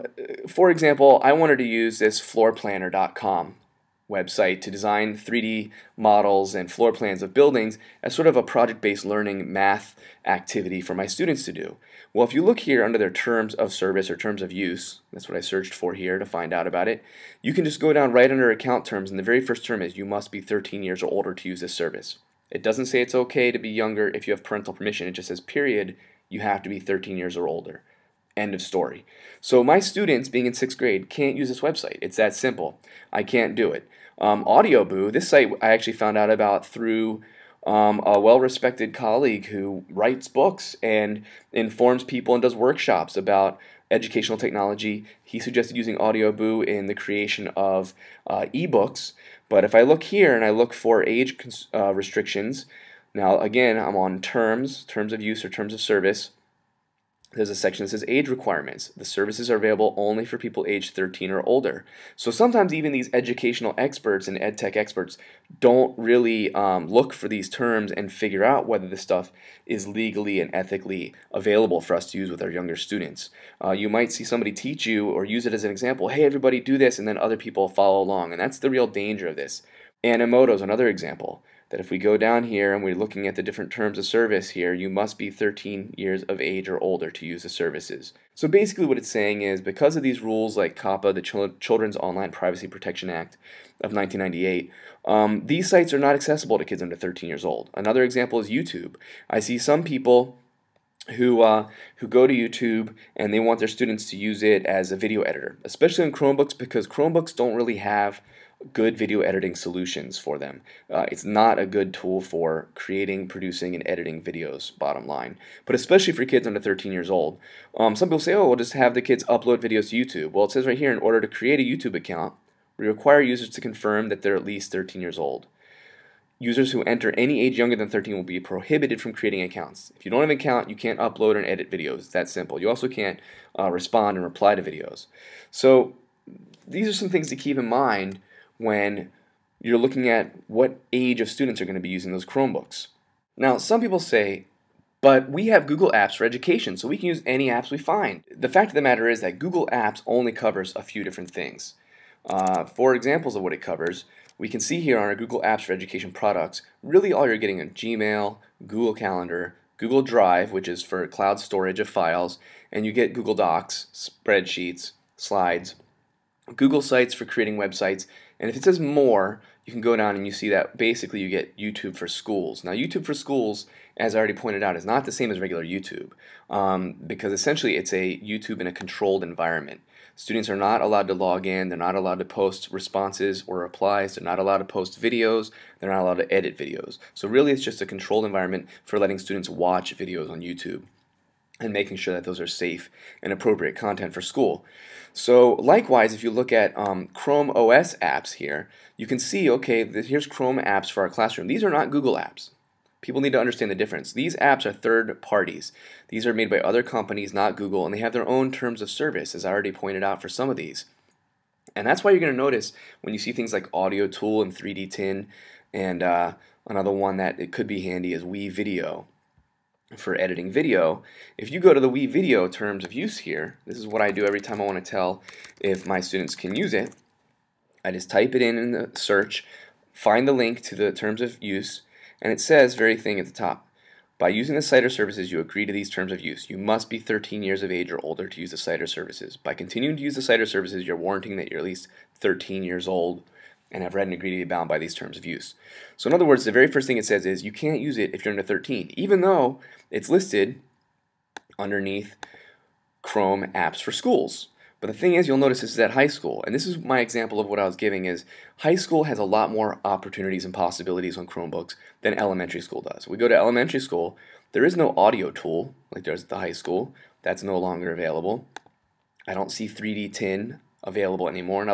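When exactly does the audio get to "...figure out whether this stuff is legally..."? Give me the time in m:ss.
1:08.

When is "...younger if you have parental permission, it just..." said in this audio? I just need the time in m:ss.
0:23.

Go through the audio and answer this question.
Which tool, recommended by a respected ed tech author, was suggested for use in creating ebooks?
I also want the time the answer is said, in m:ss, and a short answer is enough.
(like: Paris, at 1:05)
AudioBoo, at 0:45.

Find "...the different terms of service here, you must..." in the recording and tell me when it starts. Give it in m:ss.
1:23.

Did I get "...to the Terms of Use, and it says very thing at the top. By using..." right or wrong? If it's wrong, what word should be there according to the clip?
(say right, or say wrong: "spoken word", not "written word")
right.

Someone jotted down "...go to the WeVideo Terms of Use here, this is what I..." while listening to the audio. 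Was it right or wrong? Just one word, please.
right.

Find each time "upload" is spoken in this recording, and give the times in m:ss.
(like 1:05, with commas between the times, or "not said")
1:59, 2:10.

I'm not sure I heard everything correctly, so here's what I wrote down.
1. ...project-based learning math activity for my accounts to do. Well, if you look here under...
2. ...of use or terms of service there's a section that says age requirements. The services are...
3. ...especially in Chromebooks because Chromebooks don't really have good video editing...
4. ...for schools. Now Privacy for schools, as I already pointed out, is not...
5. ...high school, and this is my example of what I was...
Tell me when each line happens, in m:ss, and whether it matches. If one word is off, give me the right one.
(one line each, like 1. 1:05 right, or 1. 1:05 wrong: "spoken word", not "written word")
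1. 0:08 wrong: "students", not "accounts"
2. 0:55 right
3. 1:45 right
4. 2:51 wrong: "YouTube", not "Privacy"
5. 4:15 right.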